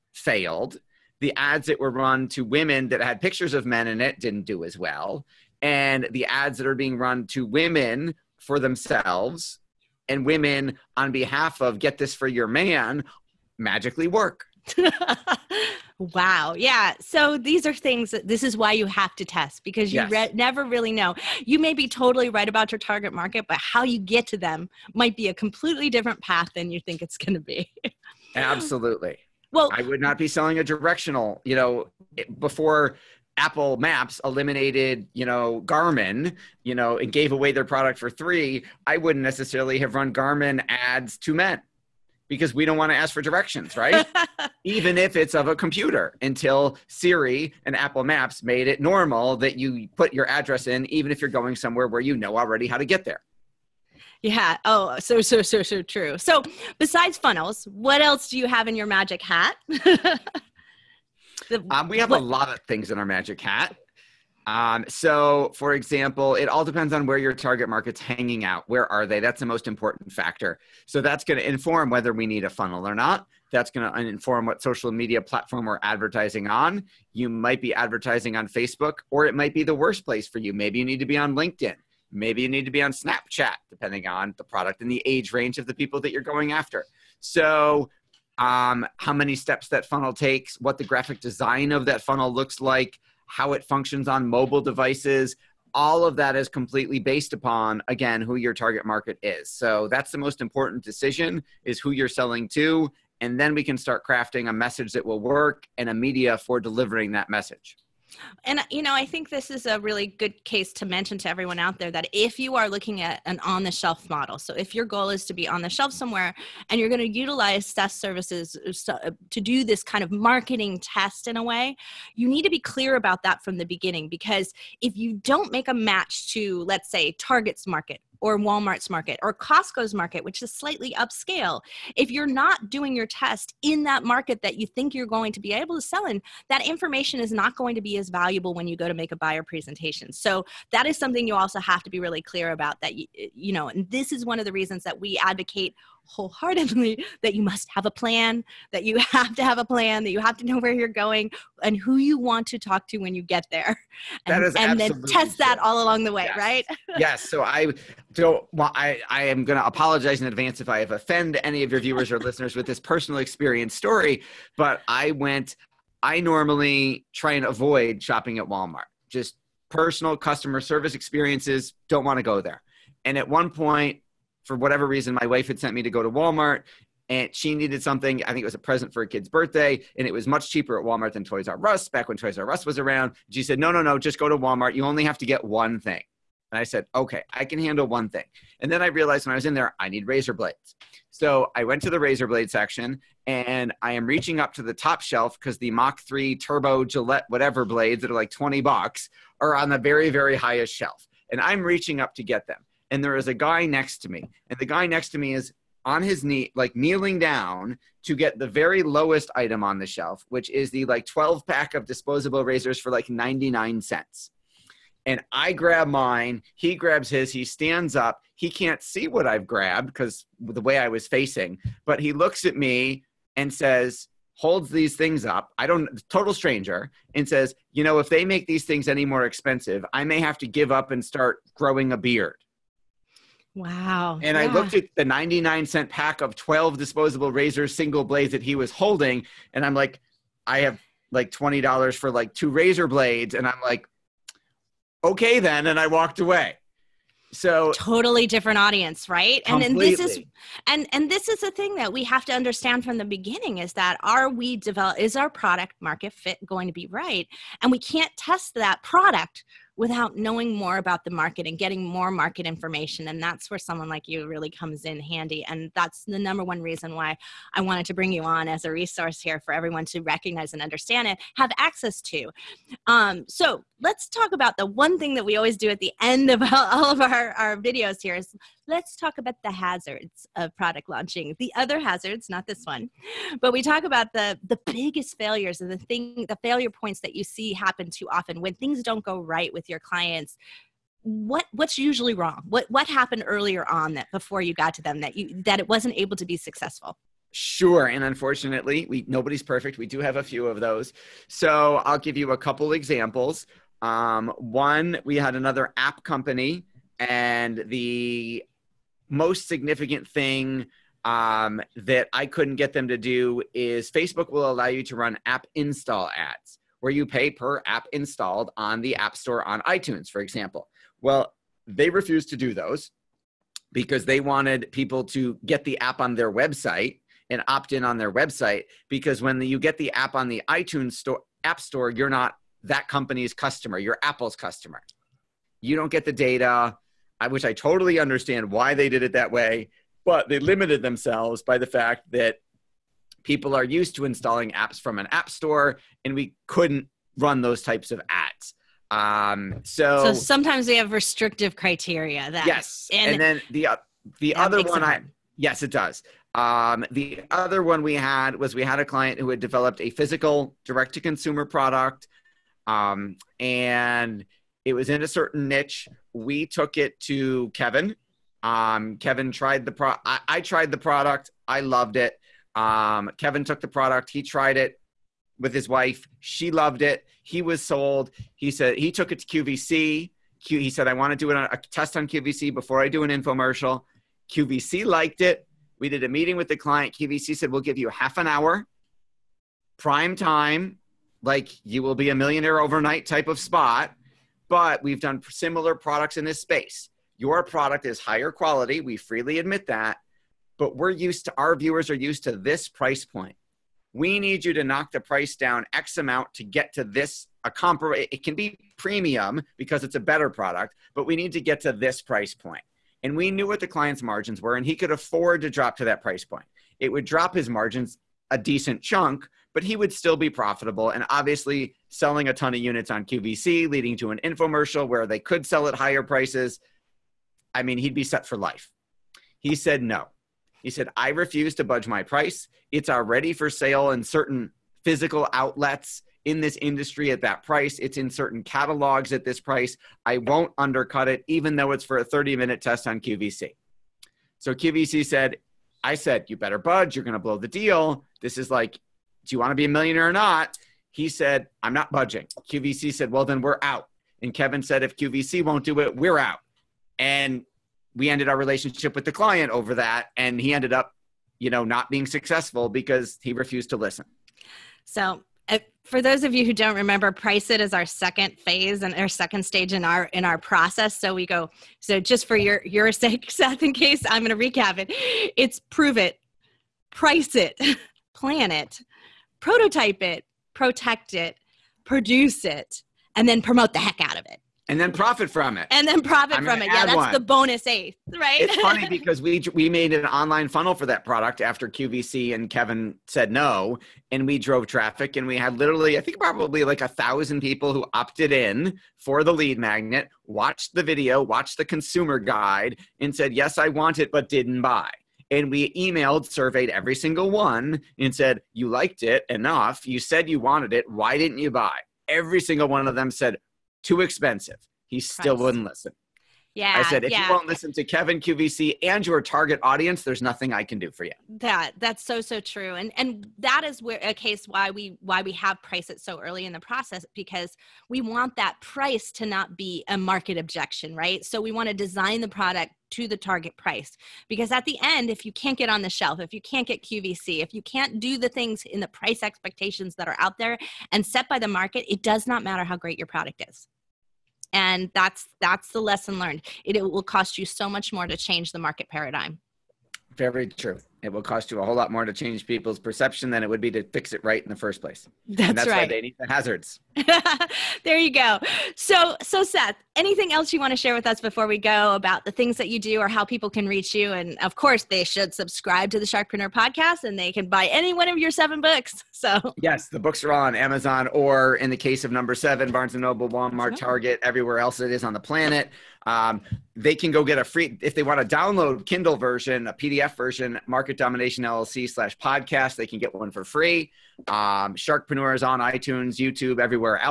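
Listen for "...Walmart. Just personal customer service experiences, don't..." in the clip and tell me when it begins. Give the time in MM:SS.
02:48.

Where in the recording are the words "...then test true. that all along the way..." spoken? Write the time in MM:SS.
02:34.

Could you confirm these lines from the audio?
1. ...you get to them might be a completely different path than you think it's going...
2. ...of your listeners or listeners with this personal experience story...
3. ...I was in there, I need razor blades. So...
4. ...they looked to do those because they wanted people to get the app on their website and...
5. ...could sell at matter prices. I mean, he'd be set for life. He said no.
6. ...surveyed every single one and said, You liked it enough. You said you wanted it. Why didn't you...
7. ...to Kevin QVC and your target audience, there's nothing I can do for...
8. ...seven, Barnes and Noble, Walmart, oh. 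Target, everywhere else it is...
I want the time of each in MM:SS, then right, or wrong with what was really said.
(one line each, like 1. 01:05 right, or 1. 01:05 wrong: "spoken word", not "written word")
1. 00:23 right
2. 02:41 wrong: "viewers", not "listeners"
3. 03:09 right
4. 05:21 wrong: "refused", not "looked"
5. 07:05 wrong: "higher", not "matter"
6. 08:26 right
7. 08:37 right
8. 09:32 right.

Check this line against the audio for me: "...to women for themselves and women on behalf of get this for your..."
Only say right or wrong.
right.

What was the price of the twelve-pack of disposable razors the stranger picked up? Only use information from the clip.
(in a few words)
99 cents.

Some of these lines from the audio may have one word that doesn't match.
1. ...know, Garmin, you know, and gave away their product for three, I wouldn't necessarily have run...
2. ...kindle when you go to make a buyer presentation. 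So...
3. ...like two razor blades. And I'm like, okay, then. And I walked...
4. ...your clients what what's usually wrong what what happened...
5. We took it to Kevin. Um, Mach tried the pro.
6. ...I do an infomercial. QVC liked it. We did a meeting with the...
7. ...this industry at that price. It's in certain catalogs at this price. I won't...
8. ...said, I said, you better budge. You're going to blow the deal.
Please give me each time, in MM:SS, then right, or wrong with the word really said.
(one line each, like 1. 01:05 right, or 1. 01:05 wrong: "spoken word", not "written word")
1. 00:35 right
2. 02:18 wrong: "valuable", not "kindle"
3. 04:02 right
4. 04:49 right
5. 06:06 wrong: "Kevin", not "Mach"
6. 06:22 right
7. 07:16 right
8. 07:25 right.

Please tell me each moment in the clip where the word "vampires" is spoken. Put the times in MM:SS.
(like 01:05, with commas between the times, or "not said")
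not said.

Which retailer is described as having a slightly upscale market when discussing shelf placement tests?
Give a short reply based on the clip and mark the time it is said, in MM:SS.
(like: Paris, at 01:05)
Costco, at 02:09.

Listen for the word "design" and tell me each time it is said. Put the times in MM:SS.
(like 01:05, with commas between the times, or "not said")
01:31, 08:51.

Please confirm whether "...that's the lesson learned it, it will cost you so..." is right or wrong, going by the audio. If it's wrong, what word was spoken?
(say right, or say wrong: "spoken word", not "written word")
right.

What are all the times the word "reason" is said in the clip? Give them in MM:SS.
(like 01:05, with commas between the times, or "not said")
02:24, 02:54, 04:26.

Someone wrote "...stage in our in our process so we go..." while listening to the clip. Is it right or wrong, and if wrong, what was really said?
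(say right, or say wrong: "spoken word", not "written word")
right.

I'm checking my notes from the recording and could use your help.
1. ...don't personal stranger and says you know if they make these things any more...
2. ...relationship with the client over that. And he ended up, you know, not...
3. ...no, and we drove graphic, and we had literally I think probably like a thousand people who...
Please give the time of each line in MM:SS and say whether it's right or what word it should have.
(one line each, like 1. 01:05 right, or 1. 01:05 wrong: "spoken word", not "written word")
1. 03:45 wrong: "total", not "personal"
2. 07:38 right
3. 08:13 wrong: "traffic", not "graphic".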